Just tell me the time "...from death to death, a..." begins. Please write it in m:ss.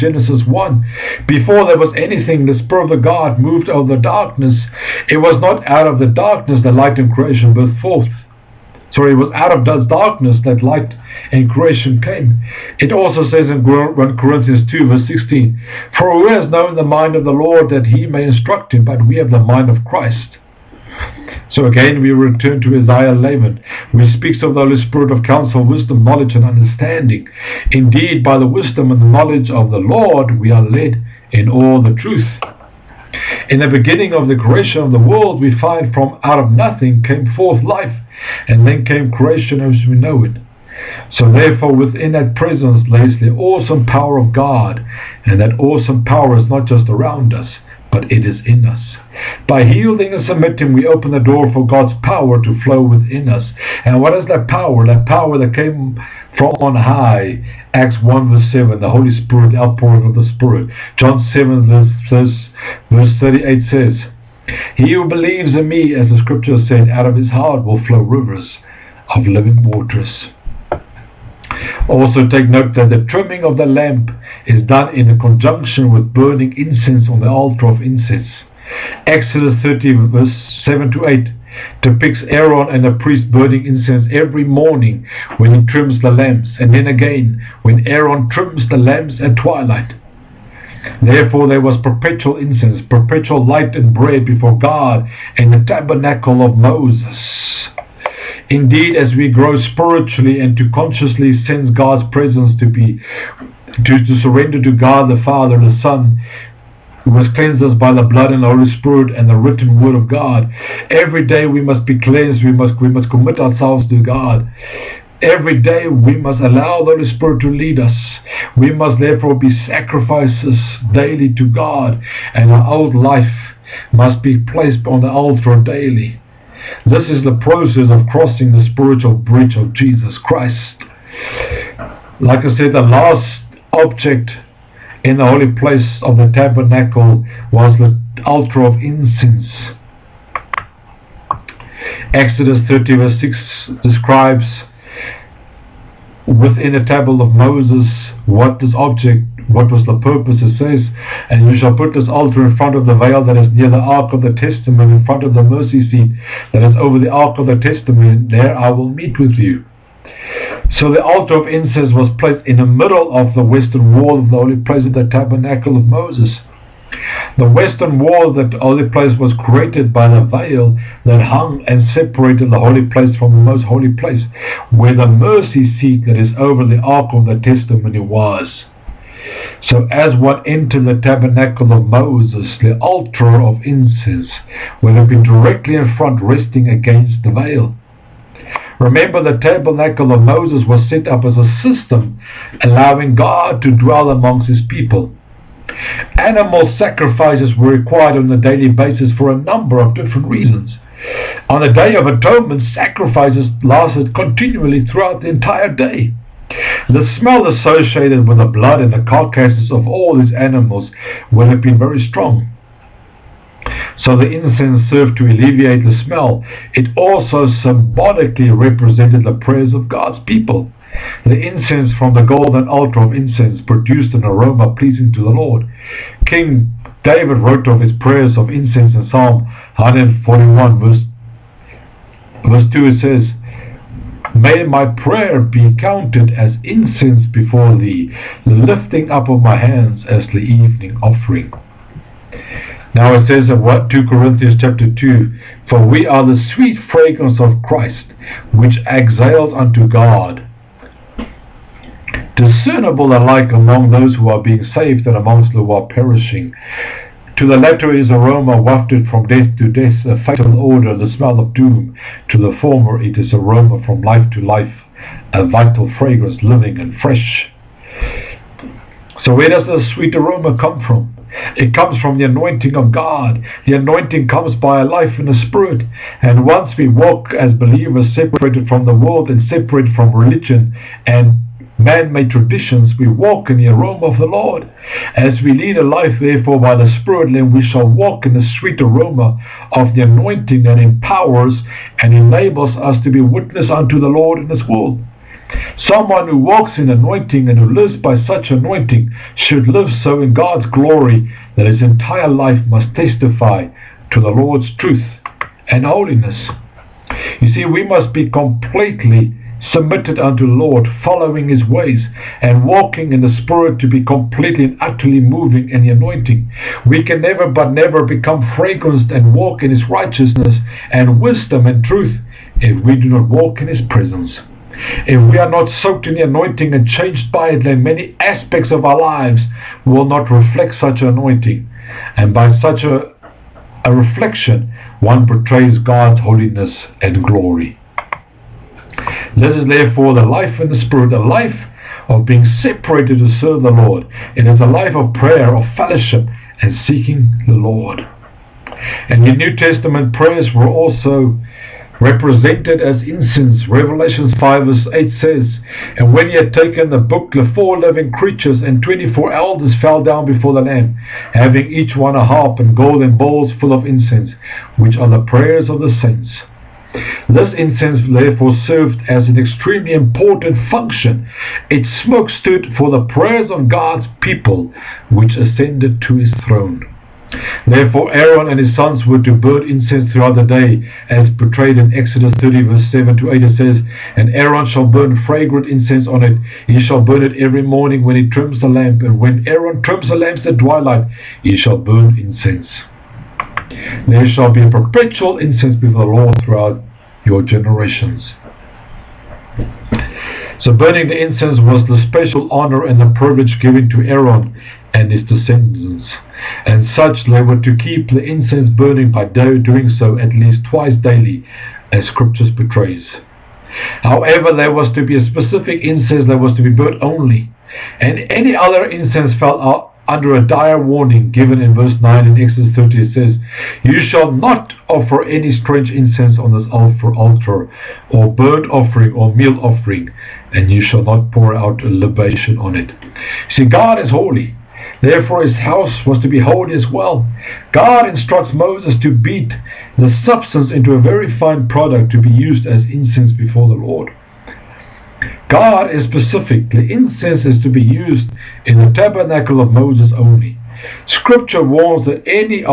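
4:19.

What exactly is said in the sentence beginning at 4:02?
Now it says of what 2 Corinthians chapter 2, For we are the sweet fragrance of Christ, which exhales unto God.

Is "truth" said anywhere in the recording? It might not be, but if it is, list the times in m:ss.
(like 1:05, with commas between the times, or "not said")
0:31, 5:04, 5:21.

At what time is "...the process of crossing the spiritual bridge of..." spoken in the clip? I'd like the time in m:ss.
2:07.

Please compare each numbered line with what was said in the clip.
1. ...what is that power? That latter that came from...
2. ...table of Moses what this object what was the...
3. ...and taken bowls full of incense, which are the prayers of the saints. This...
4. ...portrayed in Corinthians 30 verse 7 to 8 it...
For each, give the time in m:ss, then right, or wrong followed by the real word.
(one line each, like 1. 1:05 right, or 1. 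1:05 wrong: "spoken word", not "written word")
1. 0:54 wrong: "power", not "latter"
2. 2:26 right
3. 6:02 wrong: "golden", not "taken"
4. 6:21 wrong: "Exodus", not "Corinthians".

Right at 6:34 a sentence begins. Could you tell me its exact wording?
There shall be a perpetual incense before the Lord throughout your generations.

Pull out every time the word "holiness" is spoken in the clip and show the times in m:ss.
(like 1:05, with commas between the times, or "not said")
5:05, 5:36.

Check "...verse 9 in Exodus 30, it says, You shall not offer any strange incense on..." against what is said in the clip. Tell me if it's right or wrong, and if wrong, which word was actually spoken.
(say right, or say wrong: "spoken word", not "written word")
right.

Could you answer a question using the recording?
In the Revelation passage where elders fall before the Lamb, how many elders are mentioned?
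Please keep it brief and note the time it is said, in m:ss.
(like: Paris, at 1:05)
24, at 5:58.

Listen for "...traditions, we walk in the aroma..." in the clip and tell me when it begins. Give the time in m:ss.
4:42.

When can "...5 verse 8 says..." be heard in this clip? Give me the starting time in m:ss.
5:54.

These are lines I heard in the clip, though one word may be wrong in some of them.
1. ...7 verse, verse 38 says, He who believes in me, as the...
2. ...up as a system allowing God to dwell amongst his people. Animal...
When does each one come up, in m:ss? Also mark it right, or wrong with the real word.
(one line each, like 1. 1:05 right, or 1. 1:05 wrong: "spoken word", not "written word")
1. 1:01 right
2. 3:11 right.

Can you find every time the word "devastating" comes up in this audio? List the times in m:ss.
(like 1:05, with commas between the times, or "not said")
not said.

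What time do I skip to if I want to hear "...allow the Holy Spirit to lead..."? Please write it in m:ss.
1:56.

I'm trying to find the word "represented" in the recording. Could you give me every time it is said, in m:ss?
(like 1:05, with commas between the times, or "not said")
3:38, 5:51.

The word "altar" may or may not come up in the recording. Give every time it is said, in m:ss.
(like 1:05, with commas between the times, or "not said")
1:17, 2:05, 2:18, 2:32, 2:41, 3:02, 3:42, 7:06.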